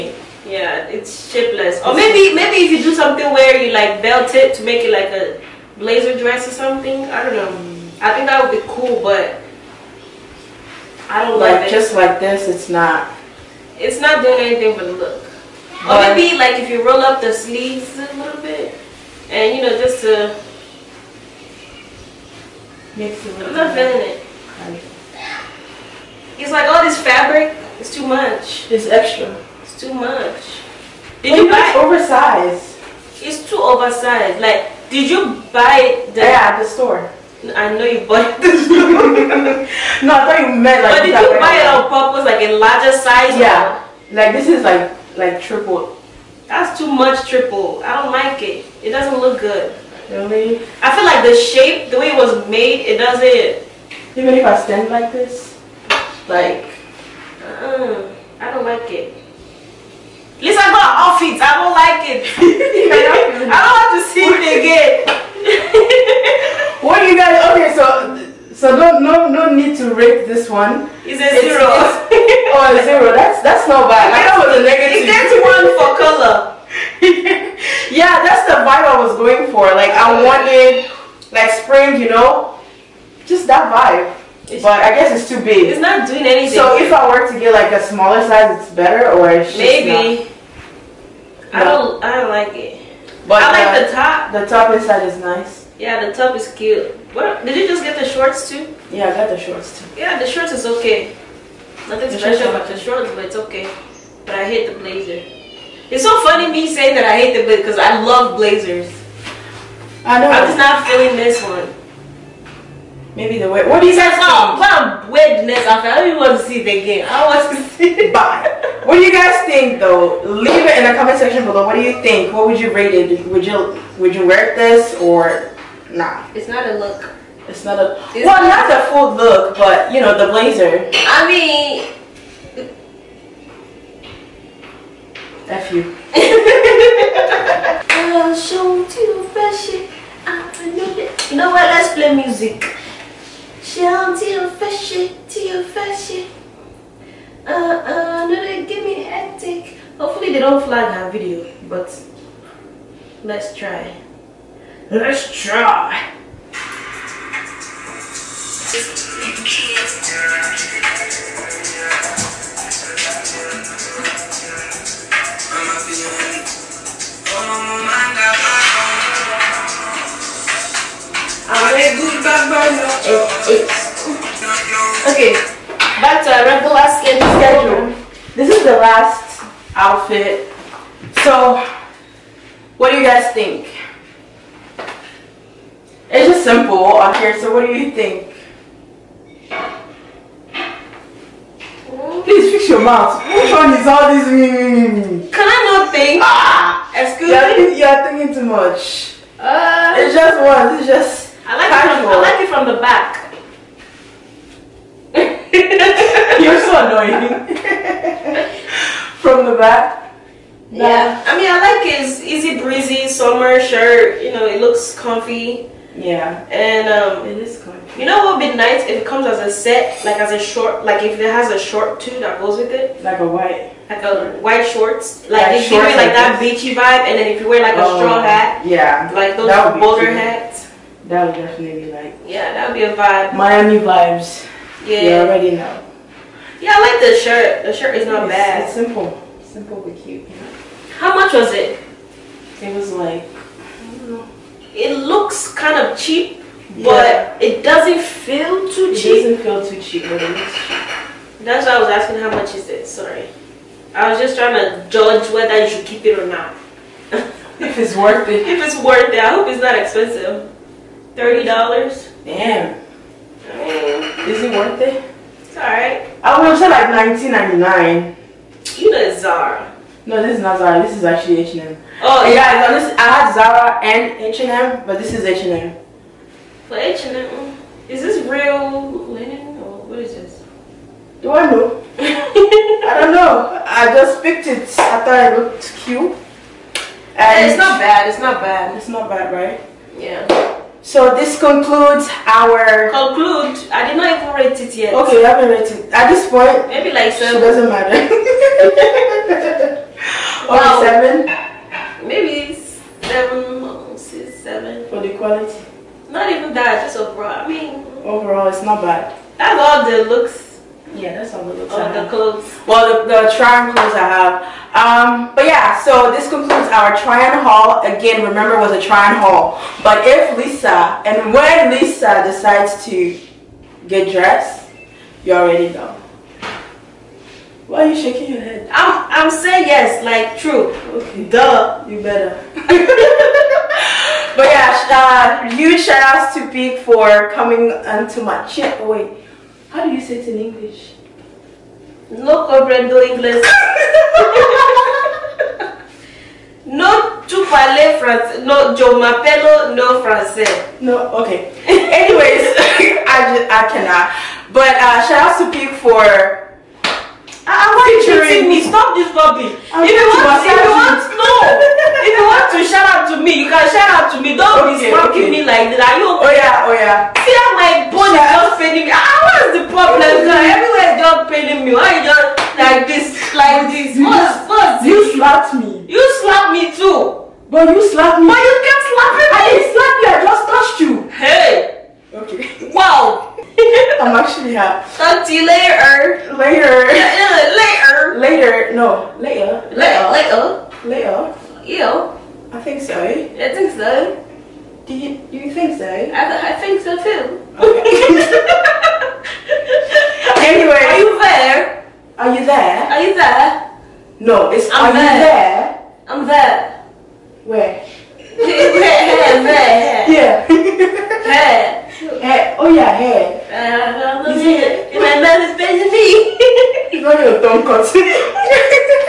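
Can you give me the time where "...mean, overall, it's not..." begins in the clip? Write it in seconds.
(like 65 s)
307 s.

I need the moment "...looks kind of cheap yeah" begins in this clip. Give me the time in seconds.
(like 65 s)
244 s.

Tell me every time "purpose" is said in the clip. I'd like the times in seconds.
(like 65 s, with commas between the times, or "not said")
41 s.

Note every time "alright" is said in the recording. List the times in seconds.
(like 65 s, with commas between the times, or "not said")
265 s.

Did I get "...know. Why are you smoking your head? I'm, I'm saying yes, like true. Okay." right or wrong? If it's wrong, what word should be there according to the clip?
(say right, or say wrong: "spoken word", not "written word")
wrong: "shaking", not "smoking".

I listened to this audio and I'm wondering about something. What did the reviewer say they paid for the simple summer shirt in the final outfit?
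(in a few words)
$30.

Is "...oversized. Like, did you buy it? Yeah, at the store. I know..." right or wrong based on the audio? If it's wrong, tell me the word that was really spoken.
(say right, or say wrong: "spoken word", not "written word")
right.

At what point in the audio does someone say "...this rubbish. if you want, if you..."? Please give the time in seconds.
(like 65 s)
358 s.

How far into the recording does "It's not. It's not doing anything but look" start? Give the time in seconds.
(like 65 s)
12 s.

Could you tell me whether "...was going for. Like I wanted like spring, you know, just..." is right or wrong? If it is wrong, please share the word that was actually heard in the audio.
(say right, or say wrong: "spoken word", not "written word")
right.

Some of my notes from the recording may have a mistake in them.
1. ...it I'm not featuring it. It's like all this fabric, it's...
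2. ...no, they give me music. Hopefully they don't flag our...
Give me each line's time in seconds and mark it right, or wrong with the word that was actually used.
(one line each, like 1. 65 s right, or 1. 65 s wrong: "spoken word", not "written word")
1. 23 s wrong: "feeling", not "featuring"
2. 148 s wrong: "hectic", not "music".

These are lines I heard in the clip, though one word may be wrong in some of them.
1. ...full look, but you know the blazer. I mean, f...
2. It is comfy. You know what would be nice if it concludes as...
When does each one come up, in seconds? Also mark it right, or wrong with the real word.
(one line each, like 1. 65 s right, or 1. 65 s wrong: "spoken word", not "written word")
1. 128 s right
2. 217 s wrong: "comes", not "concludes".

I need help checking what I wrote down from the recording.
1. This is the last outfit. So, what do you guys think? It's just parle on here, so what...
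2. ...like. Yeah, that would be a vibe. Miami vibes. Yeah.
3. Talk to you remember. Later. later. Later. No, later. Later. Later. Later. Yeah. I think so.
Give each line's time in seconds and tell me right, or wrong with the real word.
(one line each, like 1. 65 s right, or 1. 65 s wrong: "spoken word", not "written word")
1. 178 s wrong: "simple", not "parle"
2. 231 s right
3. 384 s wrong: "later", not "remember".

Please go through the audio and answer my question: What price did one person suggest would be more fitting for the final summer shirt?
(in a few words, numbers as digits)
$19.99.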